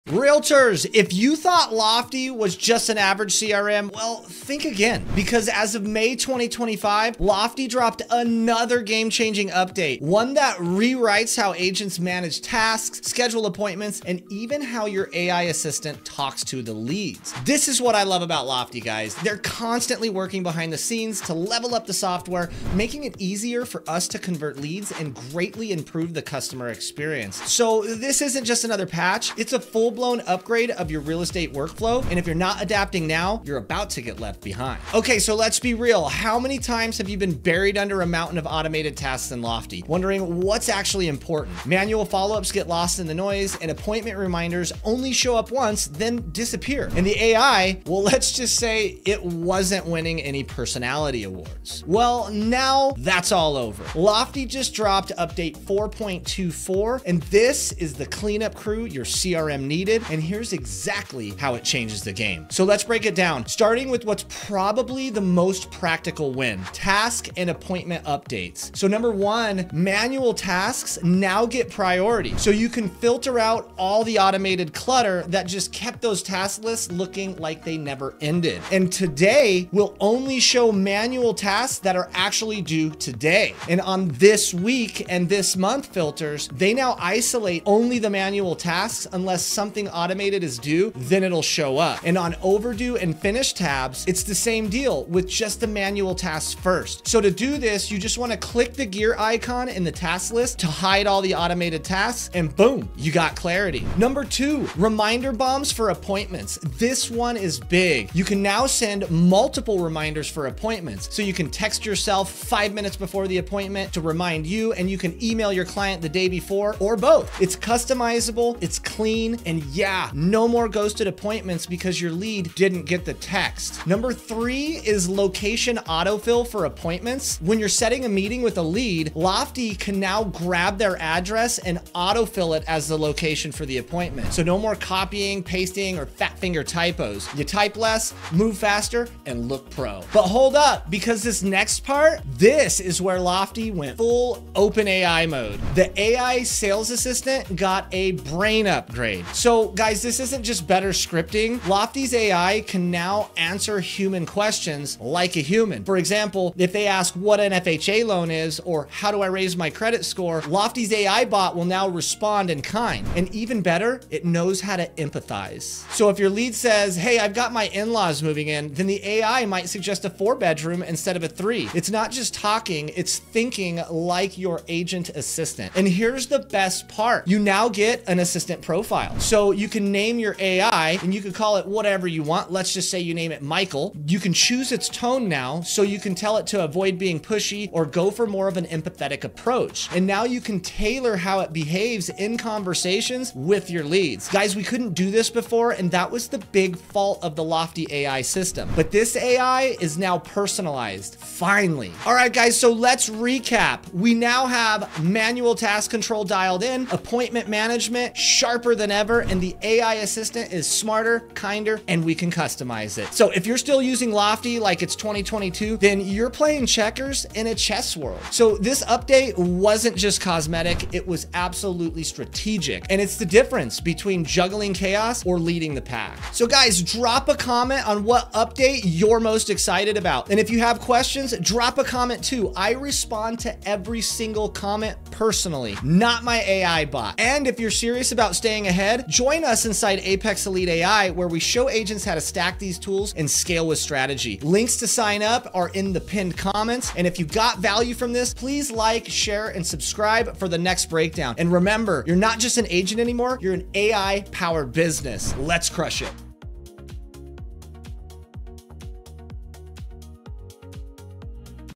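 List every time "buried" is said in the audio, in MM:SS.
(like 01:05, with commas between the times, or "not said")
00:37.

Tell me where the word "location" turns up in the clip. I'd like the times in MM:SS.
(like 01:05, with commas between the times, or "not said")
02:05, 02:12.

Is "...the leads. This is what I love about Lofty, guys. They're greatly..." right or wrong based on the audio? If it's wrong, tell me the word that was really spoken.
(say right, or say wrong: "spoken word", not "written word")
wrong: "constantly", not "greatly".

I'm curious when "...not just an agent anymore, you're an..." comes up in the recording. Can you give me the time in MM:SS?
04:12.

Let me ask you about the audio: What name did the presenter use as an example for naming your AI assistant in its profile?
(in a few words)
Michael.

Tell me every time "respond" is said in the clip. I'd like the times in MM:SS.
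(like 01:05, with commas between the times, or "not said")
02:41, 03:52.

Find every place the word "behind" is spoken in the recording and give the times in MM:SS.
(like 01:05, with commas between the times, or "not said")
00:20, 00:34.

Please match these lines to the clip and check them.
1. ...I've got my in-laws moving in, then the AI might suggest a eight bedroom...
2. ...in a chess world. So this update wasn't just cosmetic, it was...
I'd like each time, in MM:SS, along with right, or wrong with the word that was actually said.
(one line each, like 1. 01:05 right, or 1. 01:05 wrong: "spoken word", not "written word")
1. 02:47 wrong: "four", not "eight"
2. 03:37 right.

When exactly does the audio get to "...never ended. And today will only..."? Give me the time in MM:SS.
01:17.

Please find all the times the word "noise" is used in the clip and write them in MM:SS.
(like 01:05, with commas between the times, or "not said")
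00:43.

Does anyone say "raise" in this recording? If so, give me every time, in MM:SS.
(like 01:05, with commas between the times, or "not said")
02:39.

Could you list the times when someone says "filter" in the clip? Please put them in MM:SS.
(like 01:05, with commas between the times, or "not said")
01:12, 01:25.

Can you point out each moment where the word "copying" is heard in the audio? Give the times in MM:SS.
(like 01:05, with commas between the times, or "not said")
02:14.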